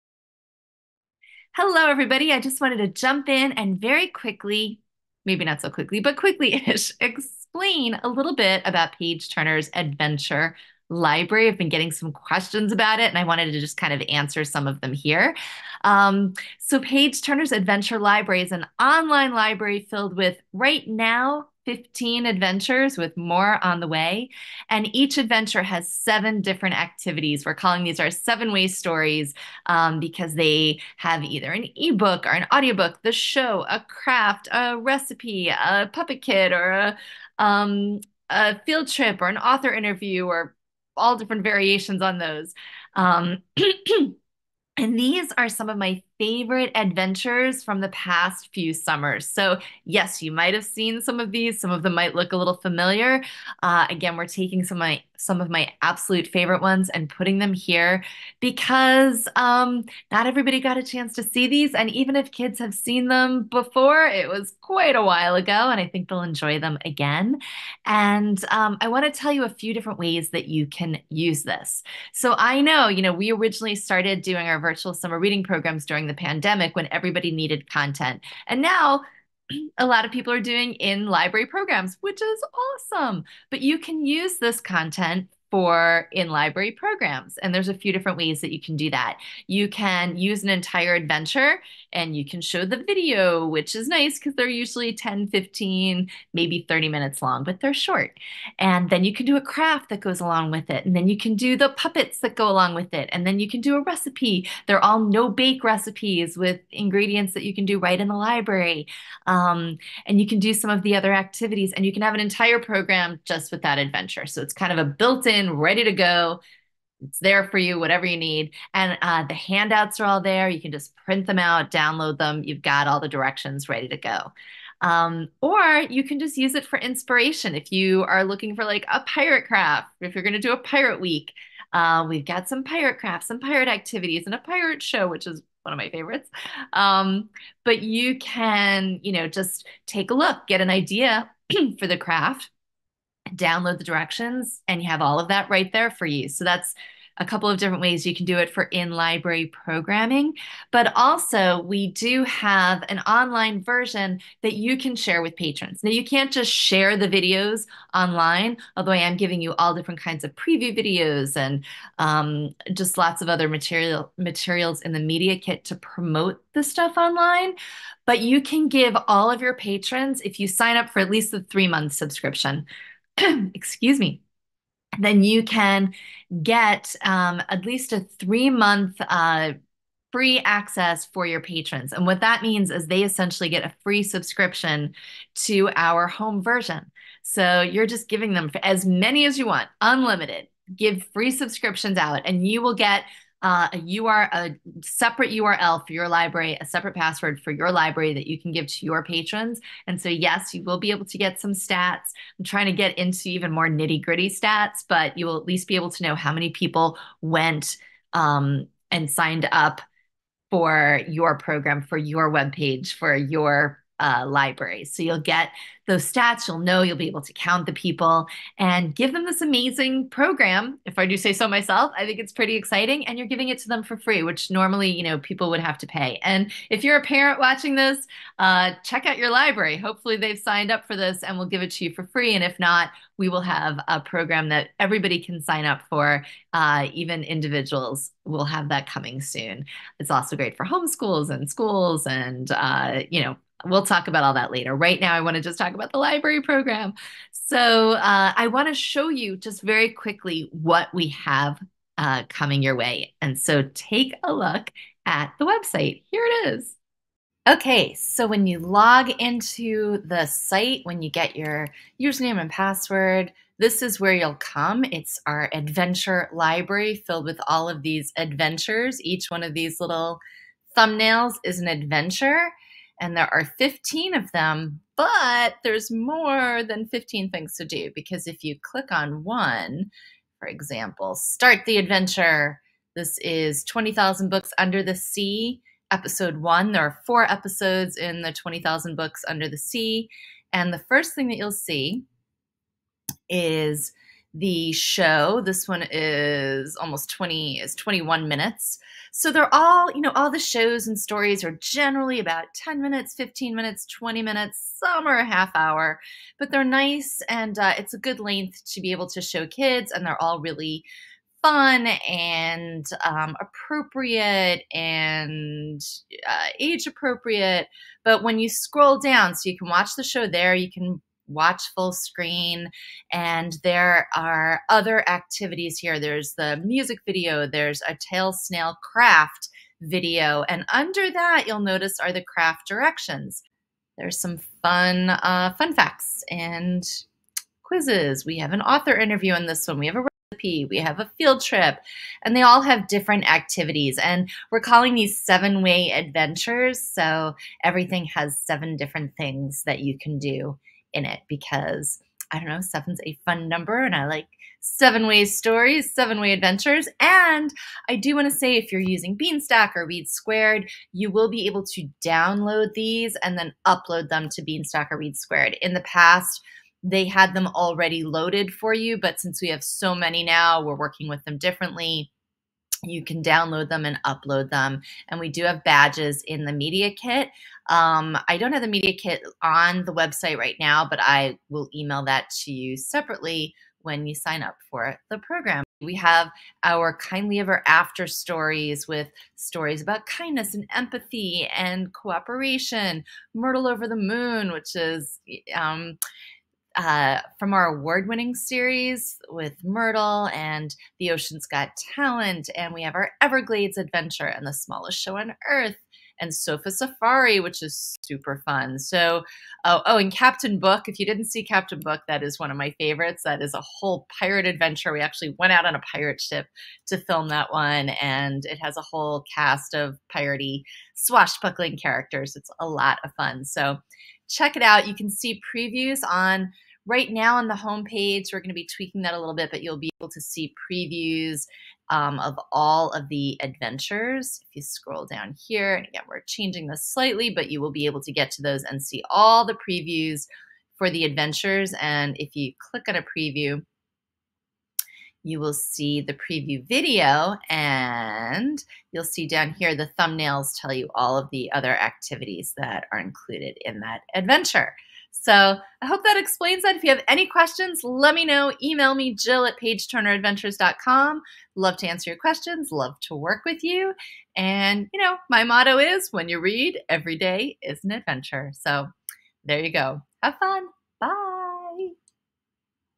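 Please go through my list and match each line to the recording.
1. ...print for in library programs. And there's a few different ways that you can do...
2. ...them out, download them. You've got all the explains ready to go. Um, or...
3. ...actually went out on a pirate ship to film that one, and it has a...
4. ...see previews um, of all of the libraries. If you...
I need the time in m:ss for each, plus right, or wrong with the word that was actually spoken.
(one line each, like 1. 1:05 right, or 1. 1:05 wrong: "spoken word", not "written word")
1. 1:24 wrong: "content", not "print"
2. 2:01 wrong: "directions", not "explains"
3. 6:54 right
4. 7:10 wrong: "adventures", not "libraries".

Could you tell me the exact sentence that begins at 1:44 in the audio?
They're all no bake recipes with ingredients that you can do right in the library.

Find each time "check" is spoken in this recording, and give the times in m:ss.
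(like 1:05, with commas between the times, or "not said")
3:48, 7:04.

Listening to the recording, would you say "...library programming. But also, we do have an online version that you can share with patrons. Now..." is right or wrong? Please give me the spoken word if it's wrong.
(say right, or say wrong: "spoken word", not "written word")
right.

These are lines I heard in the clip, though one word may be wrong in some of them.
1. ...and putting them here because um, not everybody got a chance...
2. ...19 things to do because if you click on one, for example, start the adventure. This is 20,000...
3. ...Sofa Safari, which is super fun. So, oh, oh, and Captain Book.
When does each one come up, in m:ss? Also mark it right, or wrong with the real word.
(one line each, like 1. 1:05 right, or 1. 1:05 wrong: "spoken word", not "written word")
1. 0:56 right
2. 4:36 wrong: "15", not "19"
3. 6:46 right.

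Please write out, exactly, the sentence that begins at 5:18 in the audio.
But when you scroll down, so you can watch the show there, you can watch full screen.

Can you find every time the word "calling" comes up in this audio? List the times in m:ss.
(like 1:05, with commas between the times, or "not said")
0:27, 5:44.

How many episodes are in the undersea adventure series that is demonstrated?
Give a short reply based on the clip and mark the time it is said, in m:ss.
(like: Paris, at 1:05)
4, at 4:47.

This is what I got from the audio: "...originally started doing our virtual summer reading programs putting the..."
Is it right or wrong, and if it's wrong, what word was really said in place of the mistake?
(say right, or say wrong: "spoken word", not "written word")
wrong: "during", not "putting".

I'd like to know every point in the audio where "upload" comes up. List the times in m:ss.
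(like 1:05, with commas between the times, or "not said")
6:03, 6:14.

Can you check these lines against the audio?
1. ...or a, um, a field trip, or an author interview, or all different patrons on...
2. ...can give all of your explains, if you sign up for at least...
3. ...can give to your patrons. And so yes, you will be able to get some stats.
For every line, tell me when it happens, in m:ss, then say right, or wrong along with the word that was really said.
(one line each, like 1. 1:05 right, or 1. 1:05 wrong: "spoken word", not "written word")
1. 0:36 wrong: "variations", not "patrons"
2. 2:48 wrong: "patrons", not "explains"
3. 3:18 right.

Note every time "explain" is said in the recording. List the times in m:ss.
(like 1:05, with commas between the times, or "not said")
0:07, 7:36.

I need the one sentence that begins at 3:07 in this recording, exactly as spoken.
So you're just giving them as many as you want, unlimited.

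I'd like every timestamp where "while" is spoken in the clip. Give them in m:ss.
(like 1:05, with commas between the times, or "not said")
1:05.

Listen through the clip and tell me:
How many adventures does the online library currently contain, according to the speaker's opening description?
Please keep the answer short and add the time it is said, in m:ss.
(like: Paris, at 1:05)
15, at 0:21.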